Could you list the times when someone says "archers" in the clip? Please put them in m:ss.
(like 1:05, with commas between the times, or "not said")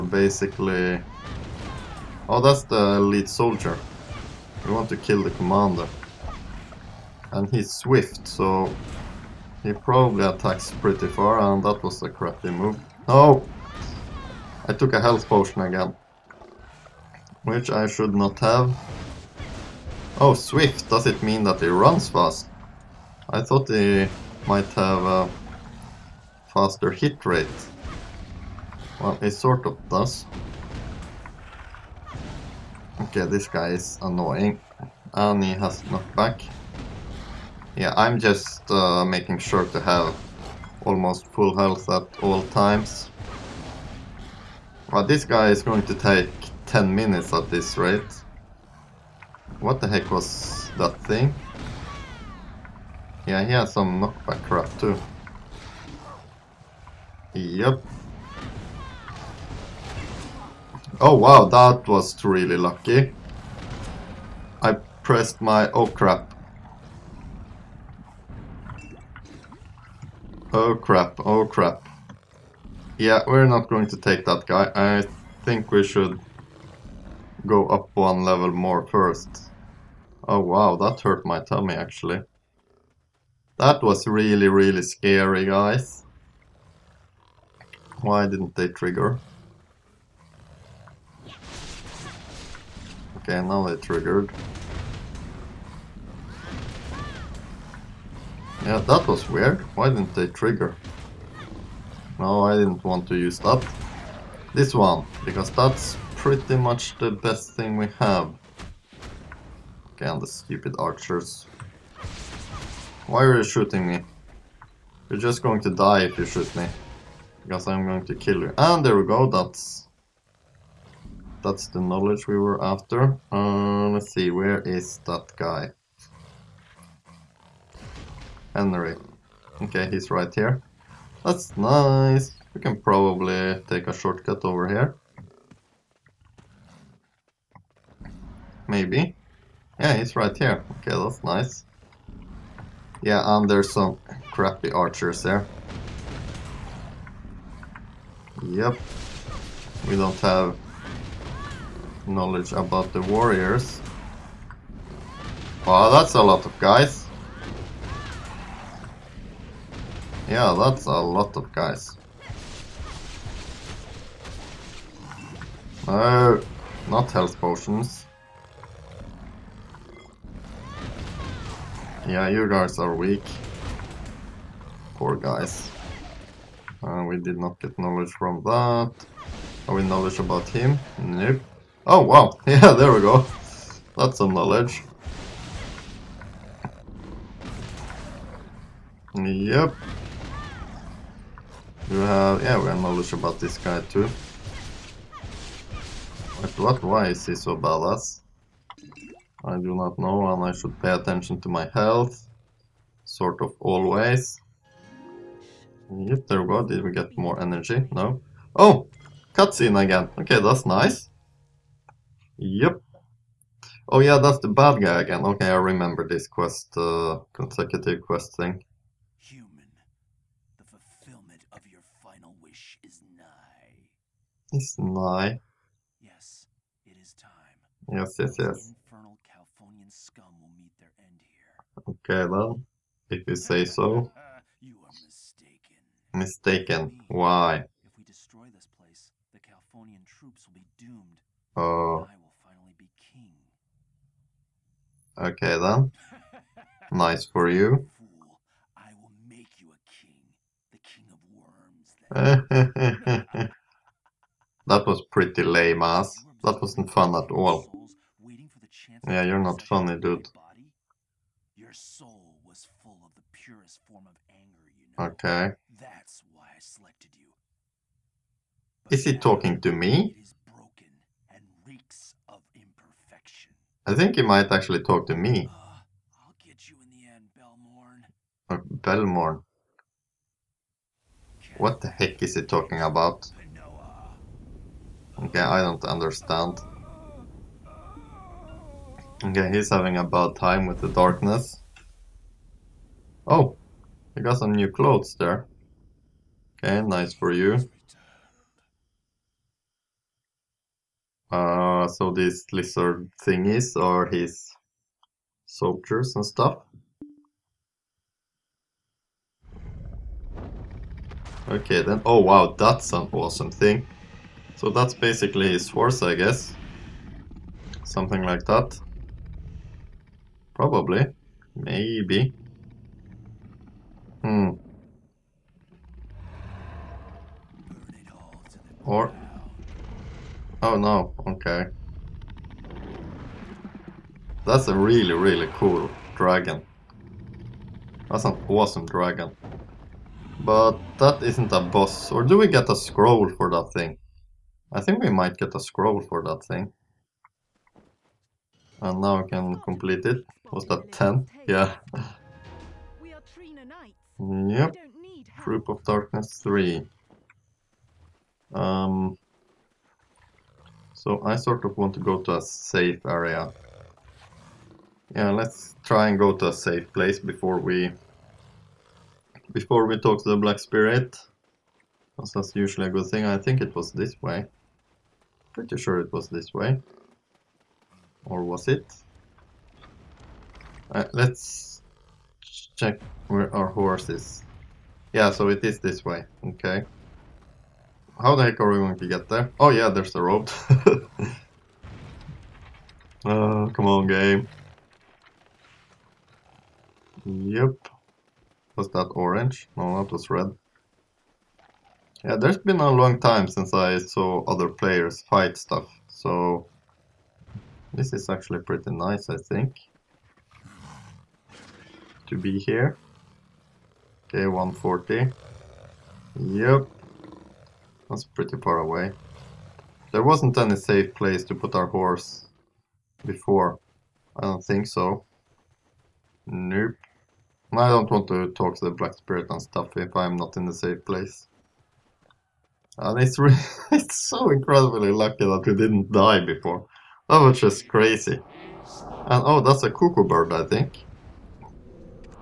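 1:50, 2:24.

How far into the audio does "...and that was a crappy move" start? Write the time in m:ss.
0:11.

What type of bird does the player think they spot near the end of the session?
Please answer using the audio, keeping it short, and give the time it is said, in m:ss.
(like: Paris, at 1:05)
Cuckoo bird, at 7:19.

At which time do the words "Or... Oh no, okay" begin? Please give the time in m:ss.
5:28.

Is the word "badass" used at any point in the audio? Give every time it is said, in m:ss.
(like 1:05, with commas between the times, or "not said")
3:17.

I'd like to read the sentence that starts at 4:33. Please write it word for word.
I think he might actually talk to me.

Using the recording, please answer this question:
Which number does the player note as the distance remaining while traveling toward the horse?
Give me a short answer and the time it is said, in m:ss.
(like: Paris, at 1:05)
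140, at 6:54.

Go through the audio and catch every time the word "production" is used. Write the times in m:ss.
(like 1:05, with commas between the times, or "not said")
not said.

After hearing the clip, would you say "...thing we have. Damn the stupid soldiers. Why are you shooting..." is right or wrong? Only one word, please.
wrong.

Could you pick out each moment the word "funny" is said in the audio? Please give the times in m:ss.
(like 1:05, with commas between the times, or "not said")
4:19.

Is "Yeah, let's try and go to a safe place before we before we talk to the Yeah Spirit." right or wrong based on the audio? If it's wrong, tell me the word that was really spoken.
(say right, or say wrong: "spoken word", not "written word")
wrong: "Black", not "Yeah".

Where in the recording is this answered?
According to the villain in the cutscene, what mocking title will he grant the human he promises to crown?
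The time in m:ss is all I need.
4:10.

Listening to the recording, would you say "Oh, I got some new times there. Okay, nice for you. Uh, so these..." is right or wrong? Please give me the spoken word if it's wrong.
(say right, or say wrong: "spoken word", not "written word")
wrong: "clothes", not "times".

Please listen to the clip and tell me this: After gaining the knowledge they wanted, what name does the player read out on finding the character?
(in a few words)
Henry.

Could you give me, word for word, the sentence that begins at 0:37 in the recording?
Yeah, I'm just uh, making sure to have almost full health at all times.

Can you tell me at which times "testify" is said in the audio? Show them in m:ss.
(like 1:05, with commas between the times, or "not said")
not said.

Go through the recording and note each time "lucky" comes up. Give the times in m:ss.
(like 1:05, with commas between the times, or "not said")
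1:02, 7:15.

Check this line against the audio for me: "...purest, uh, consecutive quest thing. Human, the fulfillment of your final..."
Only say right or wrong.
wrong.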